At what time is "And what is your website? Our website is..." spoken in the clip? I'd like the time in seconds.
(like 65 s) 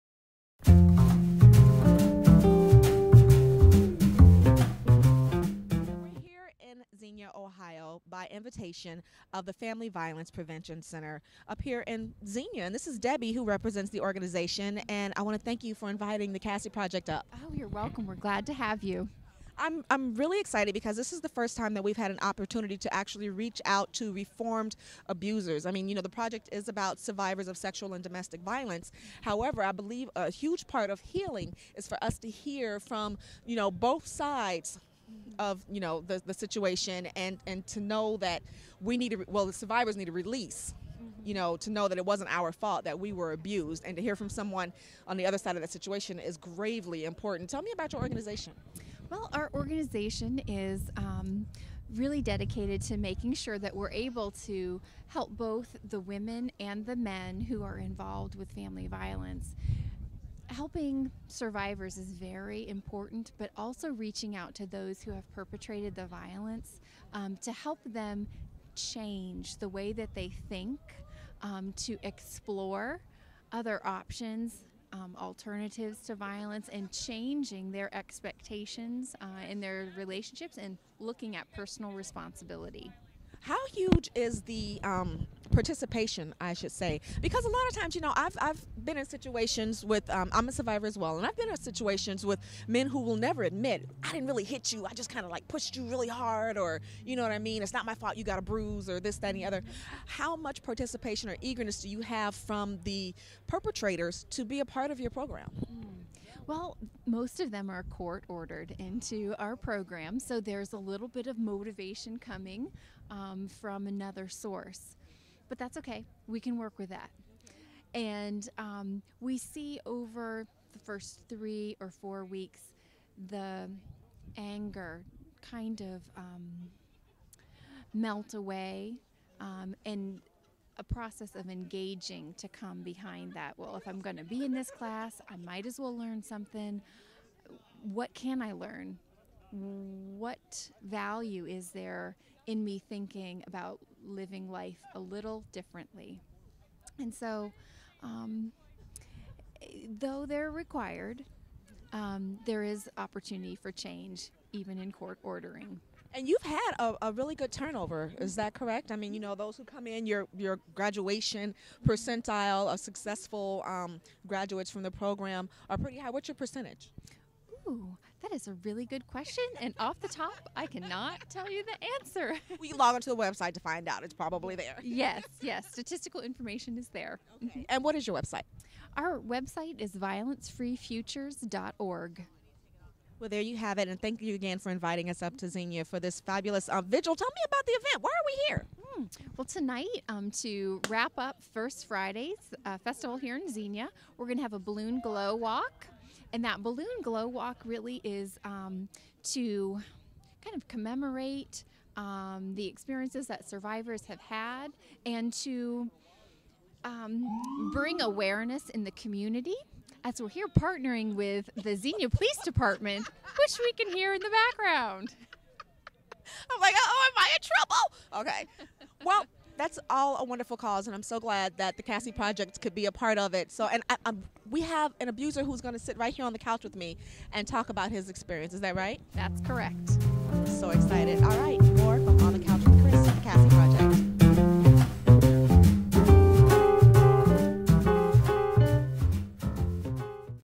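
177 s.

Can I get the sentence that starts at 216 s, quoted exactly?
I'm like, oh, am I in trouble?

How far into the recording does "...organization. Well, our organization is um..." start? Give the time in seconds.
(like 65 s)
48 s.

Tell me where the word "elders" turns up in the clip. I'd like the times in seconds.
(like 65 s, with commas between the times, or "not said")
not said.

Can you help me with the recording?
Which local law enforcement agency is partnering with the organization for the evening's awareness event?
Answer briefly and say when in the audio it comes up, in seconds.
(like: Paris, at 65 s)
Xenia Police Department, at 211 s.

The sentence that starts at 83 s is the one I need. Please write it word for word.
How huge is the um, participation, I should say?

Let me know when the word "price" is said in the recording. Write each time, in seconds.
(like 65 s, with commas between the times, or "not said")
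not said.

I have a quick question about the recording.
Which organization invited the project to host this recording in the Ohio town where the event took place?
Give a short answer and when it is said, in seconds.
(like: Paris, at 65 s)
Family Violence Prevention Center, at 9 s.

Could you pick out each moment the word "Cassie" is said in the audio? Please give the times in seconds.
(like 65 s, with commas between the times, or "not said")
16 s, 221 s.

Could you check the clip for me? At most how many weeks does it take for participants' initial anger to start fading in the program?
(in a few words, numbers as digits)
4.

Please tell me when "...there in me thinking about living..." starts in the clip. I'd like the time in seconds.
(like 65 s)
141 s.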